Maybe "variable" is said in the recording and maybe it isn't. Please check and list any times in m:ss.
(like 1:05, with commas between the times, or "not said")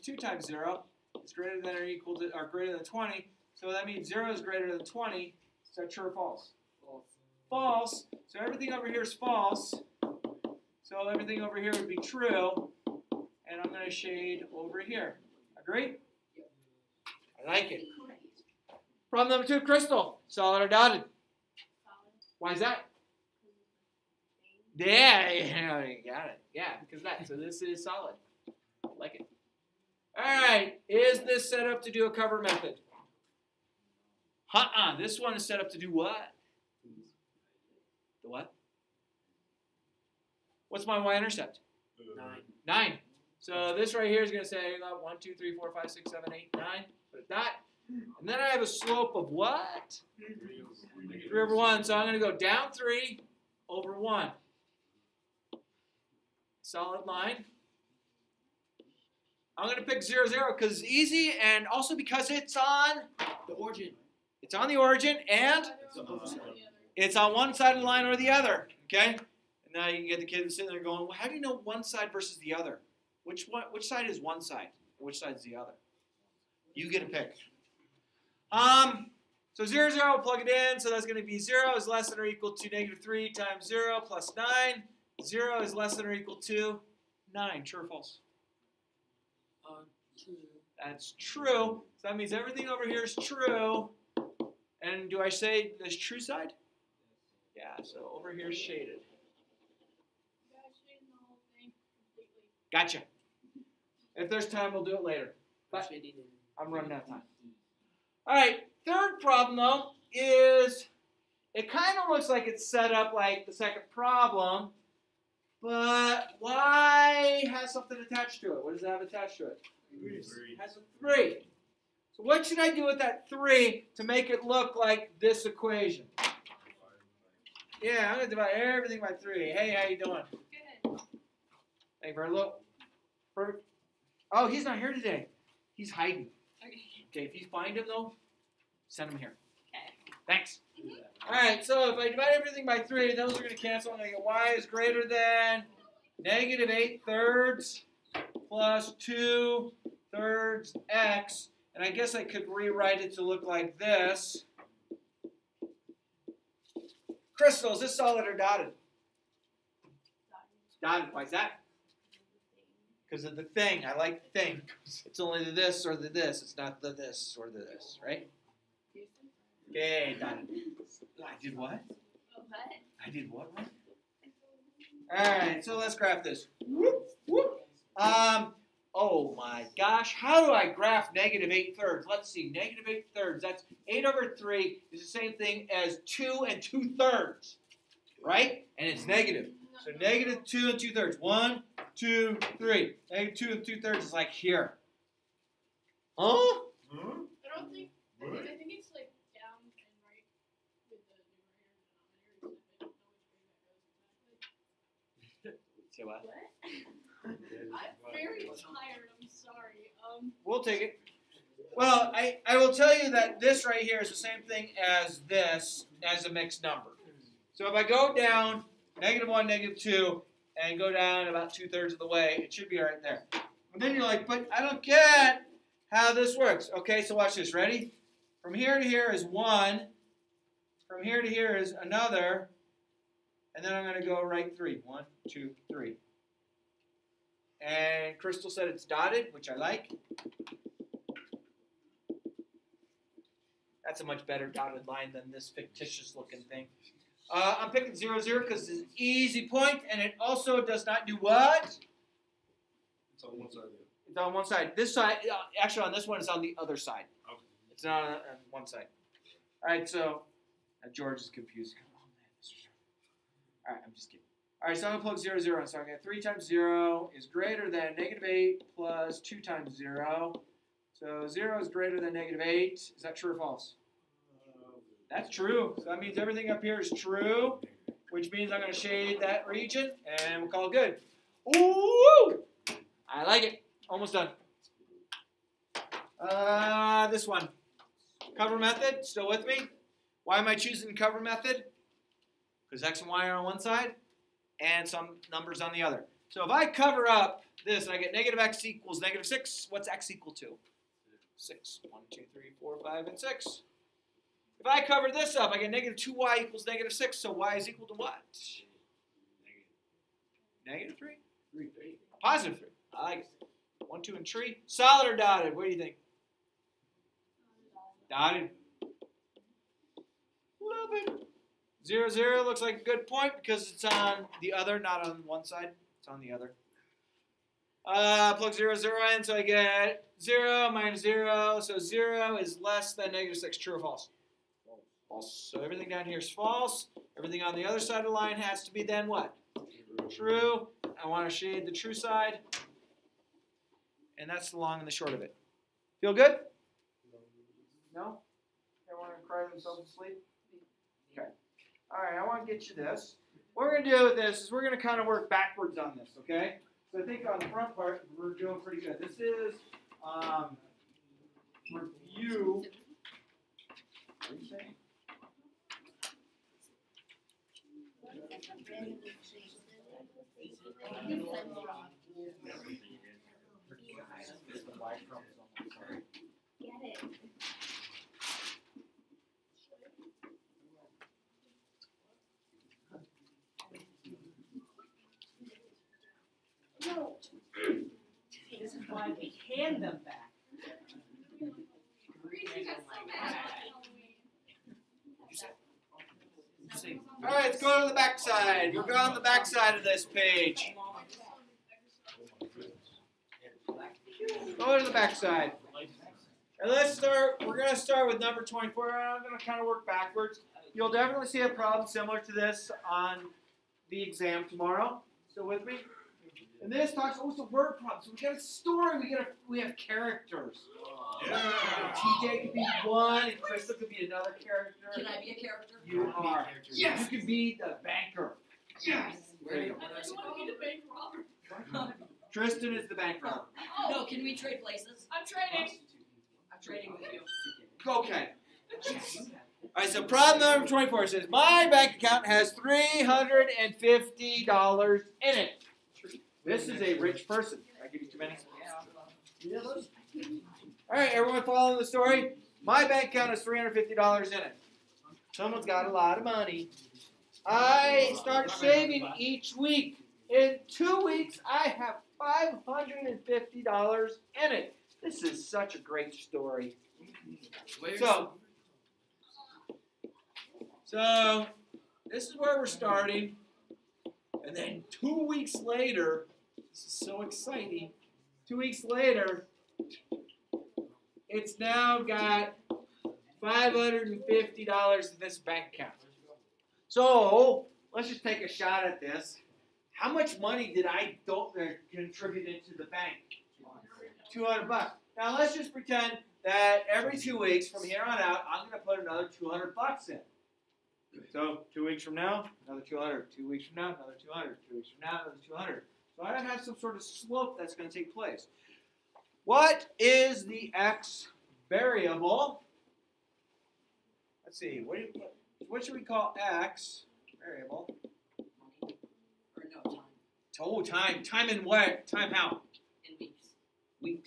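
8:31, 8:37.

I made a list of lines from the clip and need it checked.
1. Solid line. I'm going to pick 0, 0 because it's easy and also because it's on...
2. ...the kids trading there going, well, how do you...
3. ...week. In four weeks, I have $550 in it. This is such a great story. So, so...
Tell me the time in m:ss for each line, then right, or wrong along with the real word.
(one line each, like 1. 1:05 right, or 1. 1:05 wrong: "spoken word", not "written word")
1. 0:56 right
2. 1:10 wrong: "sitting", not "trading"
3. 7:39 wrong: "two", not "four".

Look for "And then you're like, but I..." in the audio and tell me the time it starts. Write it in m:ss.
3:43.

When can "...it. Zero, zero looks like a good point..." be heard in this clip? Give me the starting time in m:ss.
5:20.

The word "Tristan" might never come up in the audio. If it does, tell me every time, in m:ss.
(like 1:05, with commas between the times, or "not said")
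7:12.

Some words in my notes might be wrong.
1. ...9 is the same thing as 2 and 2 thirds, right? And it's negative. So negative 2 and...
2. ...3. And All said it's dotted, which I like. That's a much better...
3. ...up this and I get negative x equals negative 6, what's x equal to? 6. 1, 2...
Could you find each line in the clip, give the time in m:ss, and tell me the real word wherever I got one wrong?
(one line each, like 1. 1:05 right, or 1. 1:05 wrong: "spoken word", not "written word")
1. 3:04 wrong: "3", not "9"
2. 3:55 wrong: "Crystal", not "All"
3. 4:57 right.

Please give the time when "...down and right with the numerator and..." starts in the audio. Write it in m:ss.
3:19.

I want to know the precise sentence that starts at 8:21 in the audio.
So two weeks from now, another 200.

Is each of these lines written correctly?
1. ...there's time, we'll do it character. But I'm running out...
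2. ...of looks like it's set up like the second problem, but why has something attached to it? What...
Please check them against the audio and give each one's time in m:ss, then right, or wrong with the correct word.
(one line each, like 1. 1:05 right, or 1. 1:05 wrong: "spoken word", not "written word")
1. 1:44 wrong: "later", not "character"
2. 1:52 right.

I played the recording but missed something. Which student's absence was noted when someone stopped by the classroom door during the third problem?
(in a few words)
Verlo.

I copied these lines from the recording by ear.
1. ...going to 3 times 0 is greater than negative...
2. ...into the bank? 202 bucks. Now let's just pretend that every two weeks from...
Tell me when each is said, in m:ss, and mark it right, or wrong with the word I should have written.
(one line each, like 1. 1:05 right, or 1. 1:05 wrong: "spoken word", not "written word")
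1. 4:25 right
2. 8:12 wrong: "200", not "202".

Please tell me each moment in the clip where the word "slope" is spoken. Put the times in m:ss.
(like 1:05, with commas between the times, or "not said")
0:48, 8:27.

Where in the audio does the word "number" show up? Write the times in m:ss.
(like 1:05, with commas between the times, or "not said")
0:19, 3:36, 4:55, 6:48, 7:20.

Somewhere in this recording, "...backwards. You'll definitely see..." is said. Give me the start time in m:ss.
6:49.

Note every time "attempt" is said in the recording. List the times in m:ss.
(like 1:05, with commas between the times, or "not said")
not said.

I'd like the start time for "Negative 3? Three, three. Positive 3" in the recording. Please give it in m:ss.
5:10.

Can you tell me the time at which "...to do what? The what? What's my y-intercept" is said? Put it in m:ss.
0:35.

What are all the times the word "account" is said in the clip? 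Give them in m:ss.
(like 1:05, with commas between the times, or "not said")
7:21, 7:33, 8:05.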